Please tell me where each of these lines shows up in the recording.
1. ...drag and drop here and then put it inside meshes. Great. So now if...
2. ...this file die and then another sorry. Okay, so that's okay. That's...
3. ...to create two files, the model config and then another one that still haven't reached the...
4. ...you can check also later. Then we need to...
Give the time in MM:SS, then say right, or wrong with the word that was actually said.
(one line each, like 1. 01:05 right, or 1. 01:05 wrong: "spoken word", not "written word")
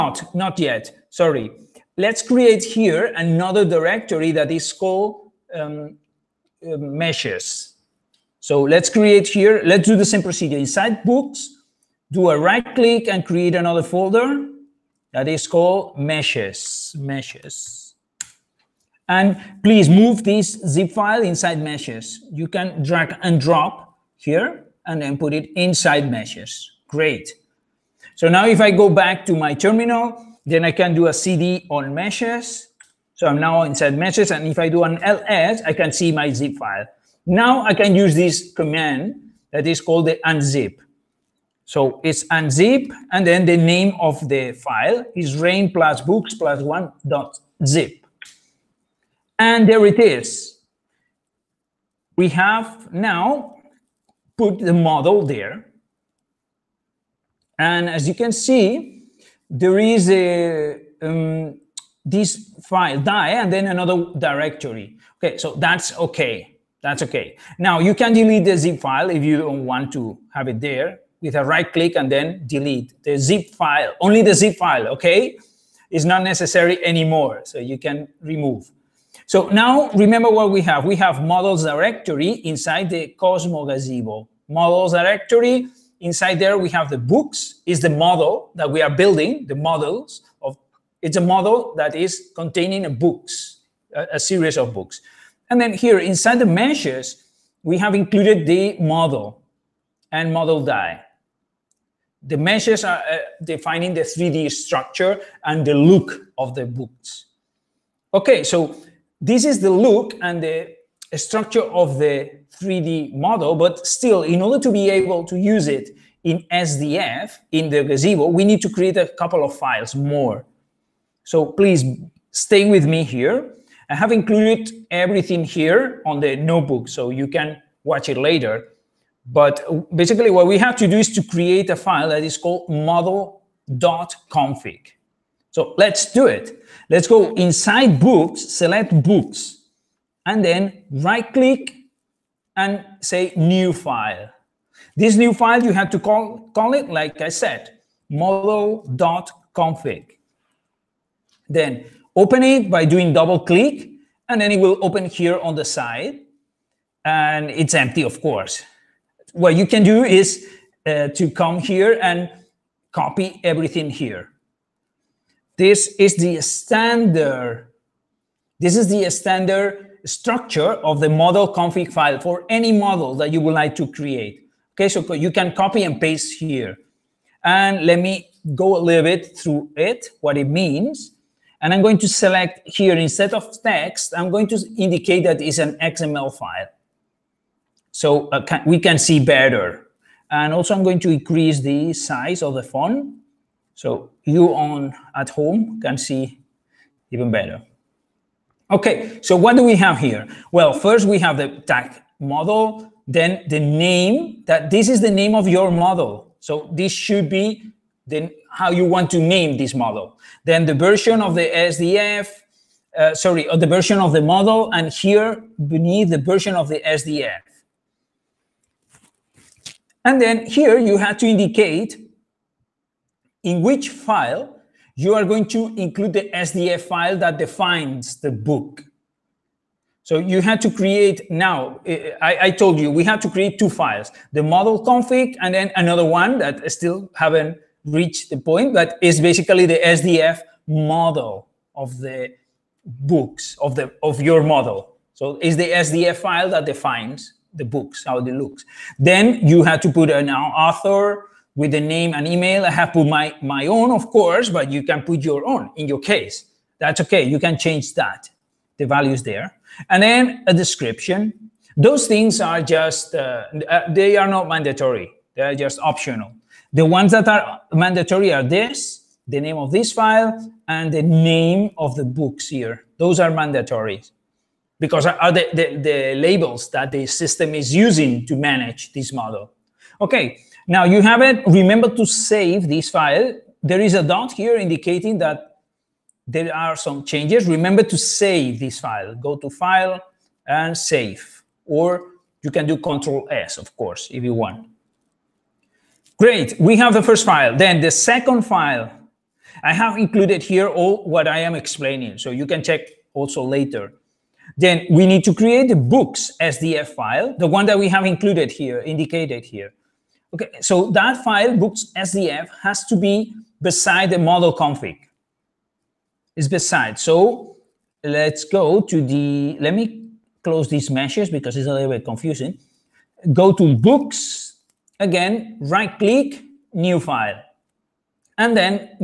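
1. 00:22 right
2. 01:02 wrong: "directory", not "sorry"
3. 03:53 right
4. 05:02 right.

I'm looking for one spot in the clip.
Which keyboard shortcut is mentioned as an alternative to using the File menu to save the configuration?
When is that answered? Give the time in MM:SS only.
04:52.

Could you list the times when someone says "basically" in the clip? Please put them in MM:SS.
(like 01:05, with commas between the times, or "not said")
02:09, 03:59.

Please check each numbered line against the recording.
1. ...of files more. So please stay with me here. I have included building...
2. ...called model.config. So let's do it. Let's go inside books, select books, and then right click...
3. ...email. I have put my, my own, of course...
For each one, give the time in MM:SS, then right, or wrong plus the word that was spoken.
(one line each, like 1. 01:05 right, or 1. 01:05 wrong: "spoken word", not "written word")
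1. 01:59 wrong: "everything", not "building"
2. 02:12 right
3. 04:12 right.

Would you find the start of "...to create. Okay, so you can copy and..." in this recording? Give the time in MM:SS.
02:53.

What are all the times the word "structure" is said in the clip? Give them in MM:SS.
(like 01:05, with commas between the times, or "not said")
01:44, 01:51, 02:50.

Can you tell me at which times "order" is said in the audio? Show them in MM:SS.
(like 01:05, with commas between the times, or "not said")
01:54.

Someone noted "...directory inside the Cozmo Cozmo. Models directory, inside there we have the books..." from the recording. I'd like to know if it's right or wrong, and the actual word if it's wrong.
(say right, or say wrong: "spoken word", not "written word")
wrong: "Gazebo", not "Cozmo".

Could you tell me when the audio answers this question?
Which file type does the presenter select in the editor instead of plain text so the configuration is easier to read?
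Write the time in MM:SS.
03:05.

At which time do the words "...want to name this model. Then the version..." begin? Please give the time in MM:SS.
03:28.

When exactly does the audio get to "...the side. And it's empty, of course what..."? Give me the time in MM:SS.
02:35.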